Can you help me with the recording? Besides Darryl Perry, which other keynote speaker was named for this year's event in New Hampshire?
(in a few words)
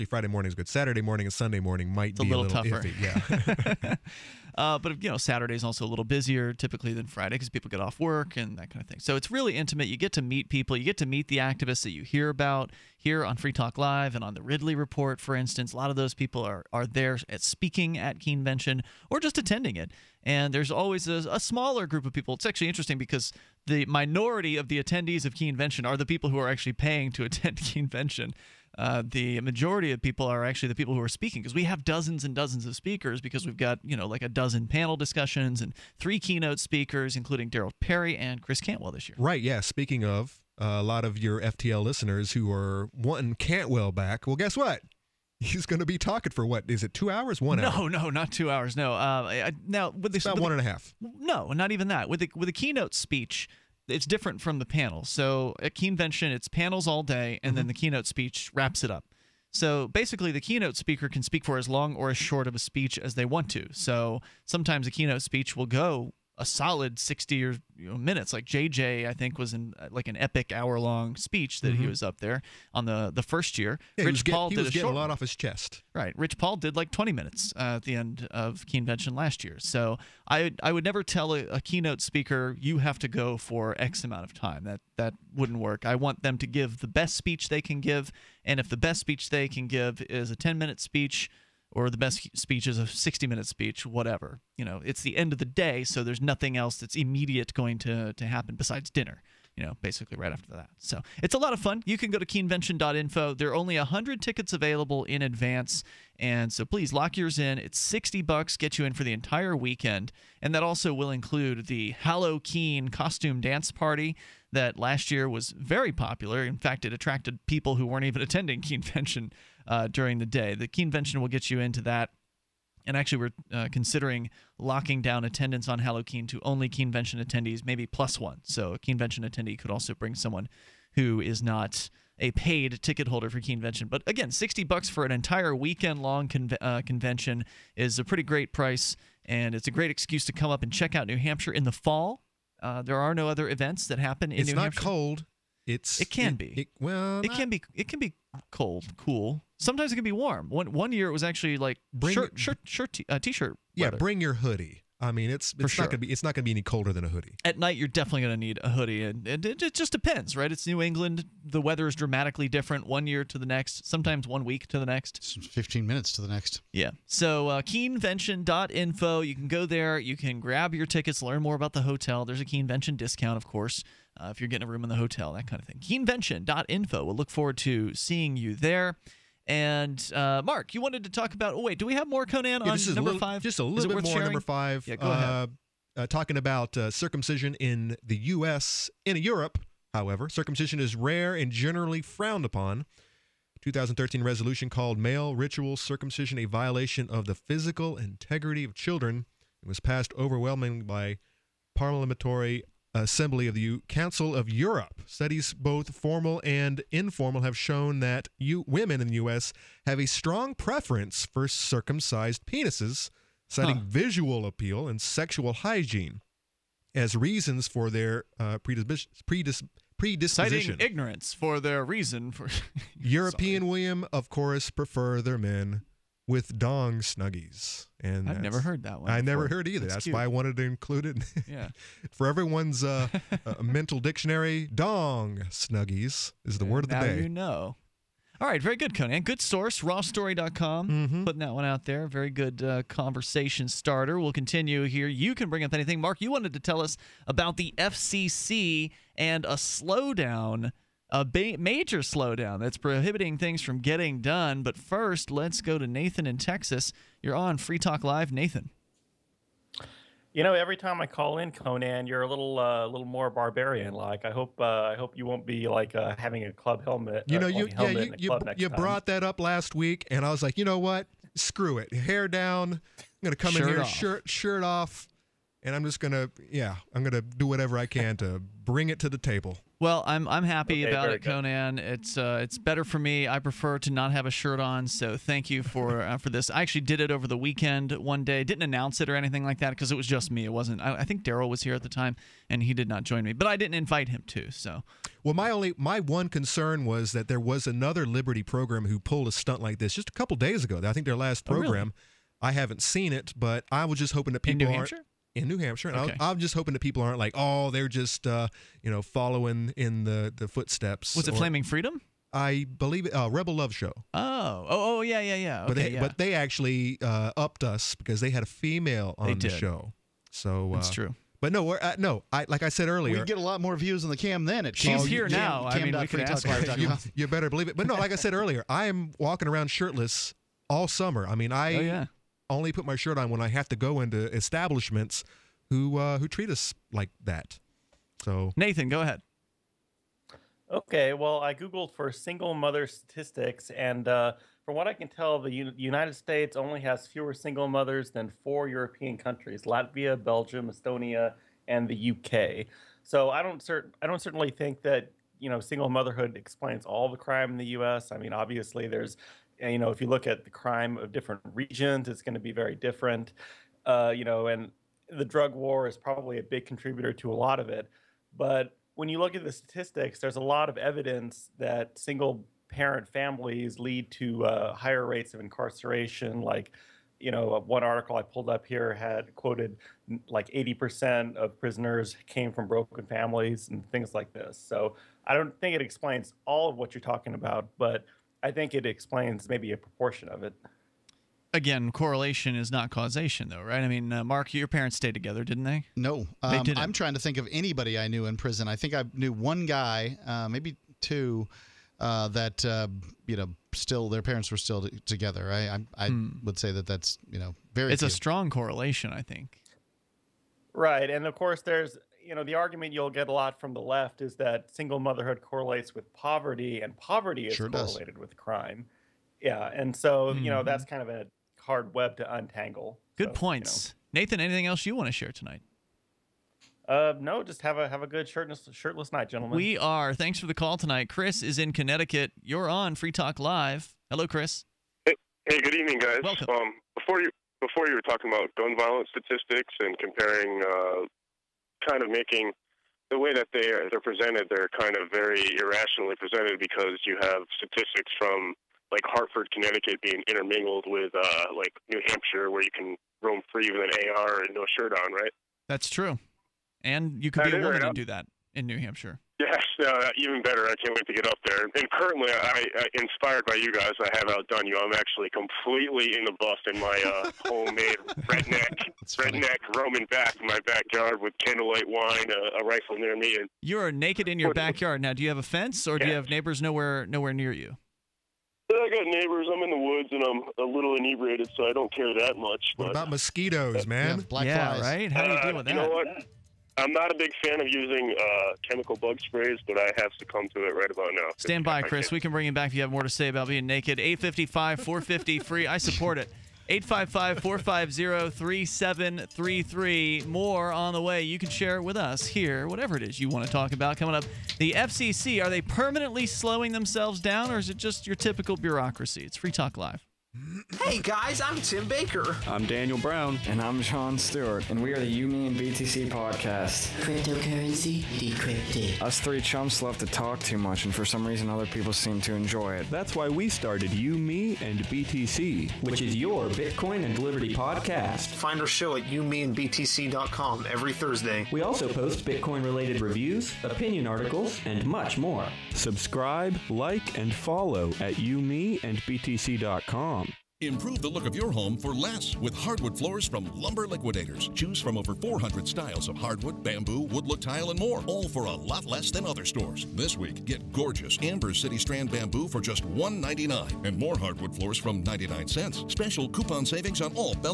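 Chris Cantwell.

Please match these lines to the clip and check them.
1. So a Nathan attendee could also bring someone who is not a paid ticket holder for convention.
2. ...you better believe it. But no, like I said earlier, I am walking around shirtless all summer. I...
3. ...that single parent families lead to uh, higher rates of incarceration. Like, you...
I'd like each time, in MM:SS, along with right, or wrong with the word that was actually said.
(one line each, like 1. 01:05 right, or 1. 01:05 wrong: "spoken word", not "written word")
1. 02:08 wrong: "Keenvention", not "Nathan"
2. 05:27 right
3. 06:11 right.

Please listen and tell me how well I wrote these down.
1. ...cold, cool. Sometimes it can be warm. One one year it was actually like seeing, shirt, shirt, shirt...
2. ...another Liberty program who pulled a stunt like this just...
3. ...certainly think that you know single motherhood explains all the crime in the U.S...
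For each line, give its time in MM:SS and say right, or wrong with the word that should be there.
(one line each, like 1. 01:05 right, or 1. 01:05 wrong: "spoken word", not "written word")
1. 02:28 wrong: "bring", not "seeing"
2. 04:57 right
3. 05:54 right.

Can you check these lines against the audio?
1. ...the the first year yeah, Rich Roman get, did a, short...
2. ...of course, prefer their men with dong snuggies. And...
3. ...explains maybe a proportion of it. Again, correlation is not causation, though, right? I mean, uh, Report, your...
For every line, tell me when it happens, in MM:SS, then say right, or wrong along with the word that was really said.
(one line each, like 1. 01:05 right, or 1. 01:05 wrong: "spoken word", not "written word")
1. 01:12 wrong: "Paul", not "Roman"
2. 03:44 right
3. 06:28 wrong: "Mark", not "Report".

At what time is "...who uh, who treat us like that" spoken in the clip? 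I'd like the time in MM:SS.
05:35.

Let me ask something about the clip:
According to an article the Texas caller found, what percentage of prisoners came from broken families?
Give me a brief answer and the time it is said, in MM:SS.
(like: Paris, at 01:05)
80%, at 06:20.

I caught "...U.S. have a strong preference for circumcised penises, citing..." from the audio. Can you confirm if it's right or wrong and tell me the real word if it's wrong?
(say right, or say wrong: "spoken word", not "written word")
right.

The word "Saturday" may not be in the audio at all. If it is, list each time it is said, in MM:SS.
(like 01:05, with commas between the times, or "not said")
00:00, 00:05.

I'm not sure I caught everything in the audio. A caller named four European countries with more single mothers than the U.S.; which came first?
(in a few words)
Latvia.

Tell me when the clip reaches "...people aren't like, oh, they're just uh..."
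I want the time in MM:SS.
05:06.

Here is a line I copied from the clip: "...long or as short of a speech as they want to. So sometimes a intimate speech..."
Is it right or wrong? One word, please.
wrong.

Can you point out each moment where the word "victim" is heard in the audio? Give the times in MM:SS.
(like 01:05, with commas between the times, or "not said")
not said.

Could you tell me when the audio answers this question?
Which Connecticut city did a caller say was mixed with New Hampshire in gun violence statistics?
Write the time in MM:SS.
07:29.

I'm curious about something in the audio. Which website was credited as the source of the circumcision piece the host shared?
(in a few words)
rawstory.com.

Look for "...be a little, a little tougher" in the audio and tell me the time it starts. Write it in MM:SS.
00:02.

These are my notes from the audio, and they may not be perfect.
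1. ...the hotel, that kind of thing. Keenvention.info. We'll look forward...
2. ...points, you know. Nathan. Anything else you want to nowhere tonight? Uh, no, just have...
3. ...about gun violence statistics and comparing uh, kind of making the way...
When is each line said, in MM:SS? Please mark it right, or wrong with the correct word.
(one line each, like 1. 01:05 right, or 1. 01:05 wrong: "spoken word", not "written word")
1. 02:54 right
2. 07:03 wrong: "share", not "nowhere"
3. 07:18 right.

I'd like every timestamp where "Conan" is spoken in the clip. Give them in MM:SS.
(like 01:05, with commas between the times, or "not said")
03:02, 03:58, 04:21, 04:41.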